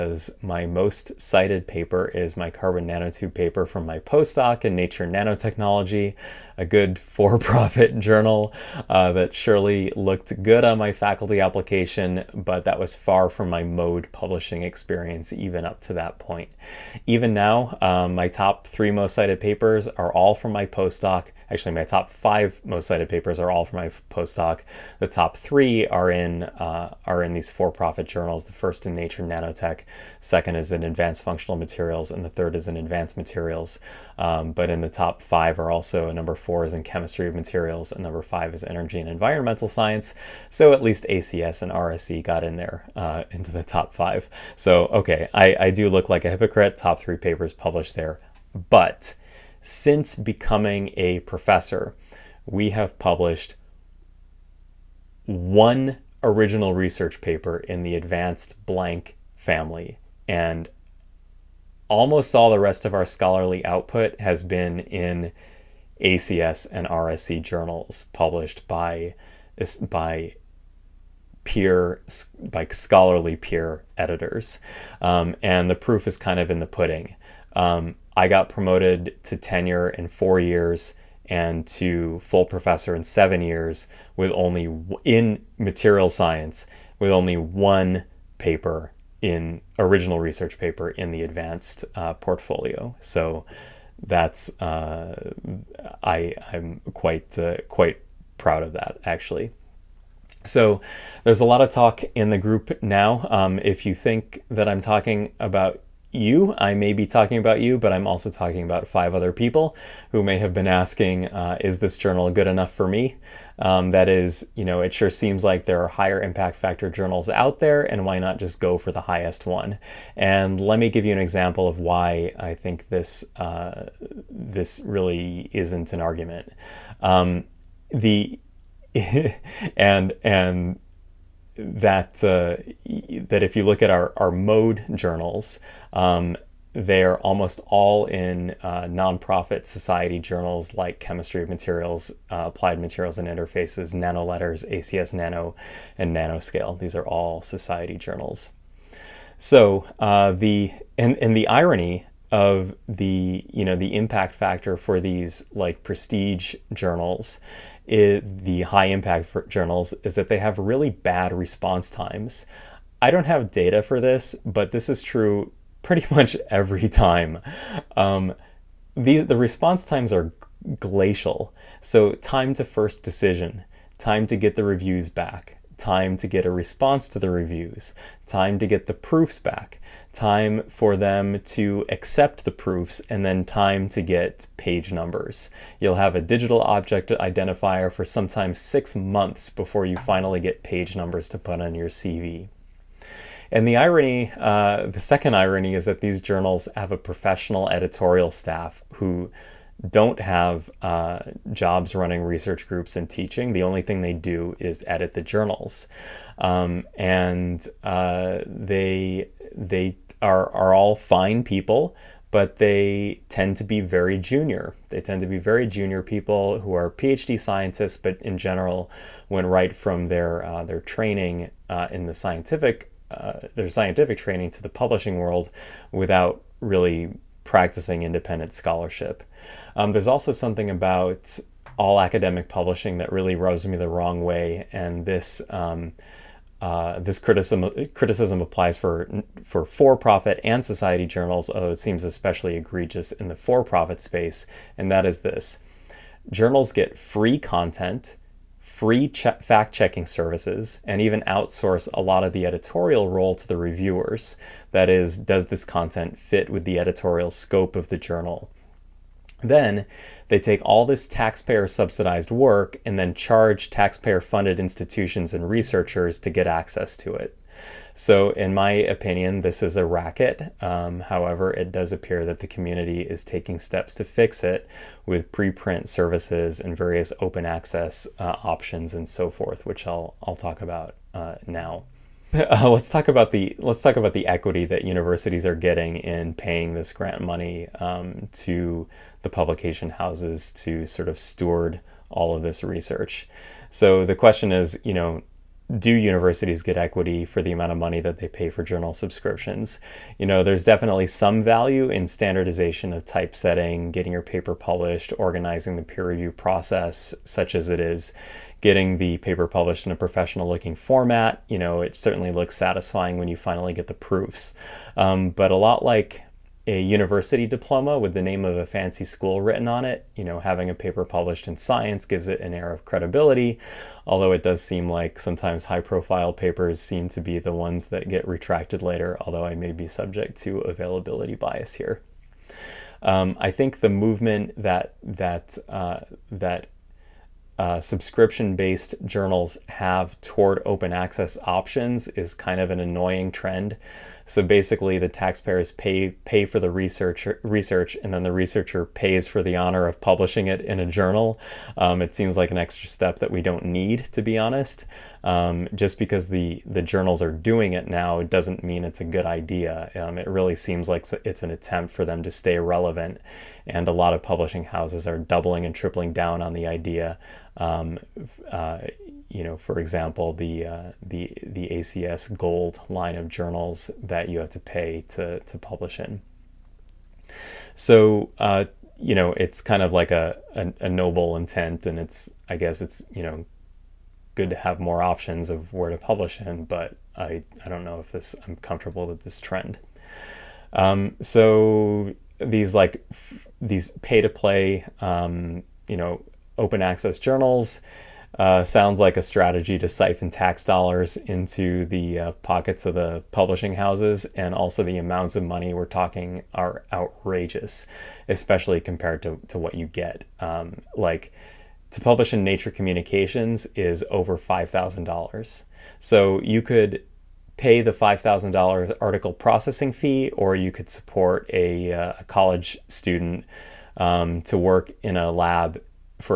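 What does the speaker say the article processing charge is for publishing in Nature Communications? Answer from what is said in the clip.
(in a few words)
over $5,000.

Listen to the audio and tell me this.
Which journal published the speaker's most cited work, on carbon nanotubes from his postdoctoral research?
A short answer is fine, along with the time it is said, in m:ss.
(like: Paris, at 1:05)
Nature Nanotechnology, at 0:04.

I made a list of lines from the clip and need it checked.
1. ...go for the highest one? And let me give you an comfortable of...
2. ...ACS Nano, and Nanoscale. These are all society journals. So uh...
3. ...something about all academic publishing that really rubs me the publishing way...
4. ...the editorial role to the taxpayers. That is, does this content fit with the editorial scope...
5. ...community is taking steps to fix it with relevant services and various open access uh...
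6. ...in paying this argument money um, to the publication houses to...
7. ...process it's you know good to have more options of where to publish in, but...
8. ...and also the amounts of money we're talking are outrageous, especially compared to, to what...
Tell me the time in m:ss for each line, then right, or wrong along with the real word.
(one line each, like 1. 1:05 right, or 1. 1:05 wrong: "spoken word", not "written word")
1. 1:58 wrong: "example", not "comfortable"
2. 2:24 right
3. 3:50 wrong: "wrong", not "publishing"
4. 4:12 wrong: "reviewers", not "taxpayers"
5. 4:32 wrong: "preprint", not "relevant"
6. 4:45 wrong: "grant", not "argument"
7. 6:22 wrong: "guess", not "process"
8. 6:44 right.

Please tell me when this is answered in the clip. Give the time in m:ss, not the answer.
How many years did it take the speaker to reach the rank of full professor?
1:23.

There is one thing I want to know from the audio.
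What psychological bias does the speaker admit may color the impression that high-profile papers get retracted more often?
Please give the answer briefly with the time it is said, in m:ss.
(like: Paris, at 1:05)
availability bias, at 5:30.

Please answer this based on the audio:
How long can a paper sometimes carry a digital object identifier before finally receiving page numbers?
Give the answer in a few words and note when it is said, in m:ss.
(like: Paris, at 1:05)
6 months, at 3:08.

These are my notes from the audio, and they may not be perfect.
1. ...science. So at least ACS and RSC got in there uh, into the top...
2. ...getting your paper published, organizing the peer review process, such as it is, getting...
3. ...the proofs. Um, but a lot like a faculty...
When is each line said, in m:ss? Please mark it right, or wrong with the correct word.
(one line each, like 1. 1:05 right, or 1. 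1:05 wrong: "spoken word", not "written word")
1. 0:39 right
2. 5:03 right
3. 5:13 wrong: "university", not "faculty".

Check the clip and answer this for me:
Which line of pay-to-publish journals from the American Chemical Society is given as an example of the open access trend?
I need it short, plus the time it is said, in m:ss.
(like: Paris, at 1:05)
ACS Gold, at 6:11.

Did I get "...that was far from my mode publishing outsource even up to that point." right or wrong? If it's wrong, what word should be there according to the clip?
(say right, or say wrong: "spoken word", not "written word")
wrong: "experience", not "outsource".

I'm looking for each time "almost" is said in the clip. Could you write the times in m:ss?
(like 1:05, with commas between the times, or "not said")
1:01, 2:17.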